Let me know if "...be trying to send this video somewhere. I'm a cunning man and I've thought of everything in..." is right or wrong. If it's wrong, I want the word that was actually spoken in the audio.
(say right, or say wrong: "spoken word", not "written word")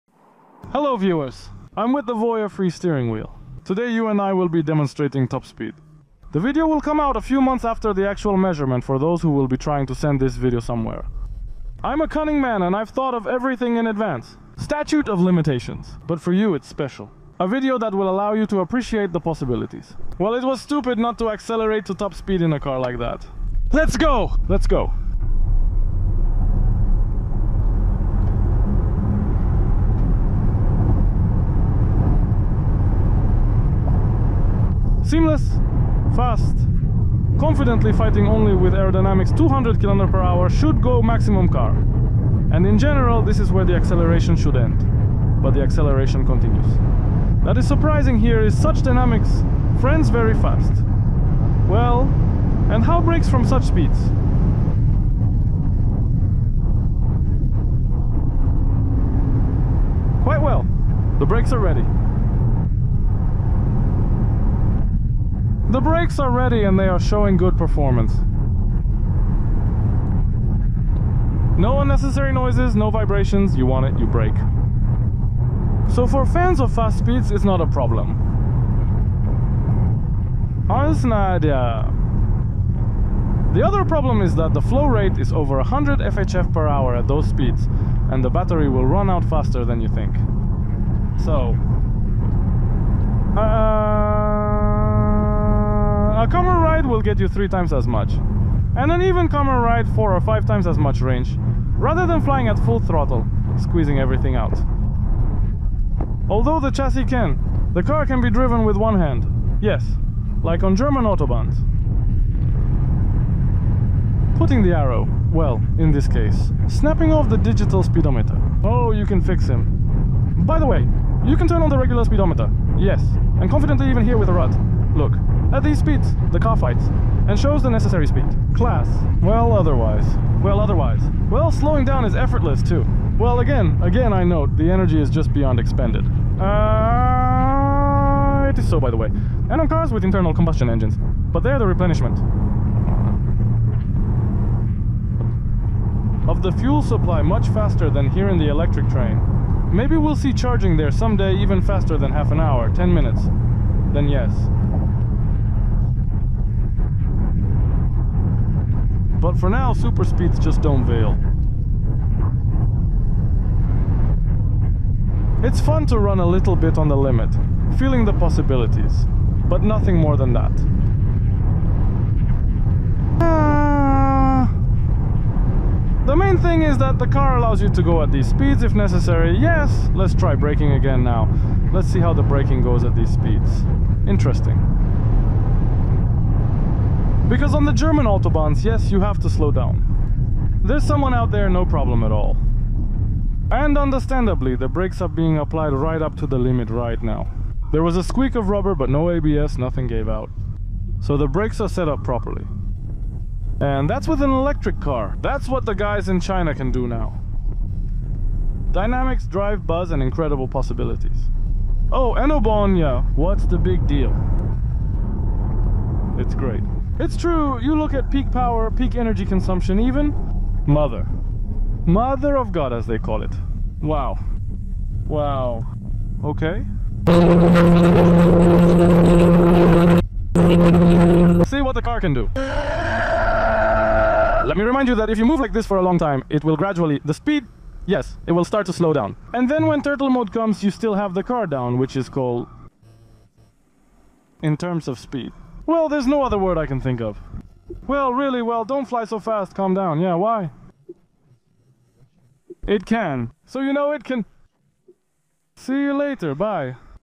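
right.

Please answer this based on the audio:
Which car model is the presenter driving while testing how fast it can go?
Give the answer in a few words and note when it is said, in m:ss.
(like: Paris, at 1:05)
Voyah Free, at 0:02.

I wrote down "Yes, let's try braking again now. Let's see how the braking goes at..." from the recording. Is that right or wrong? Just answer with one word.
right.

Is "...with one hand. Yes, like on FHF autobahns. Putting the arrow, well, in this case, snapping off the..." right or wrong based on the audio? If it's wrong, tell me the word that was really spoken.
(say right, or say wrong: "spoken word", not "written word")
wrong: "German", not "FHF".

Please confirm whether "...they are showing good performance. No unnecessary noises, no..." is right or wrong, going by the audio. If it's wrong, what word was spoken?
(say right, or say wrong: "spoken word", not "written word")
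right.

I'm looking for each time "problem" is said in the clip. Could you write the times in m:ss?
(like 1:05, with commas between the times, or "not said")
1:17, 1:23, 3:11.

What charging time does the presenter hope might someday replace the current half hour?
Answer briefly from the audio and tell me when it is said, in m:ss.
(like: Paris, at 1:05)
10 minutes, at 2:32.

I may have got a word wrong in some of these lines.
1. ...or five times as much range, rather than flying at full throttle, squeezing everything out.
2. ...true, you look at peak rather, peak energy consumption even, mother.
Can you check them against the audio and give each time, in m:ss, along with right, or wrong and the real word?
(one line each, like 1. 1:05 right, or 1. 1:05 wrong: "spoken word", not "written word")
1. 1:40 right
2. 3:37 wrong: "power", not "rather".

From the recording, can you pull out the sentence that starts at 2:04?
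Look, at these speeds, the car fights, and shows the necessary speed.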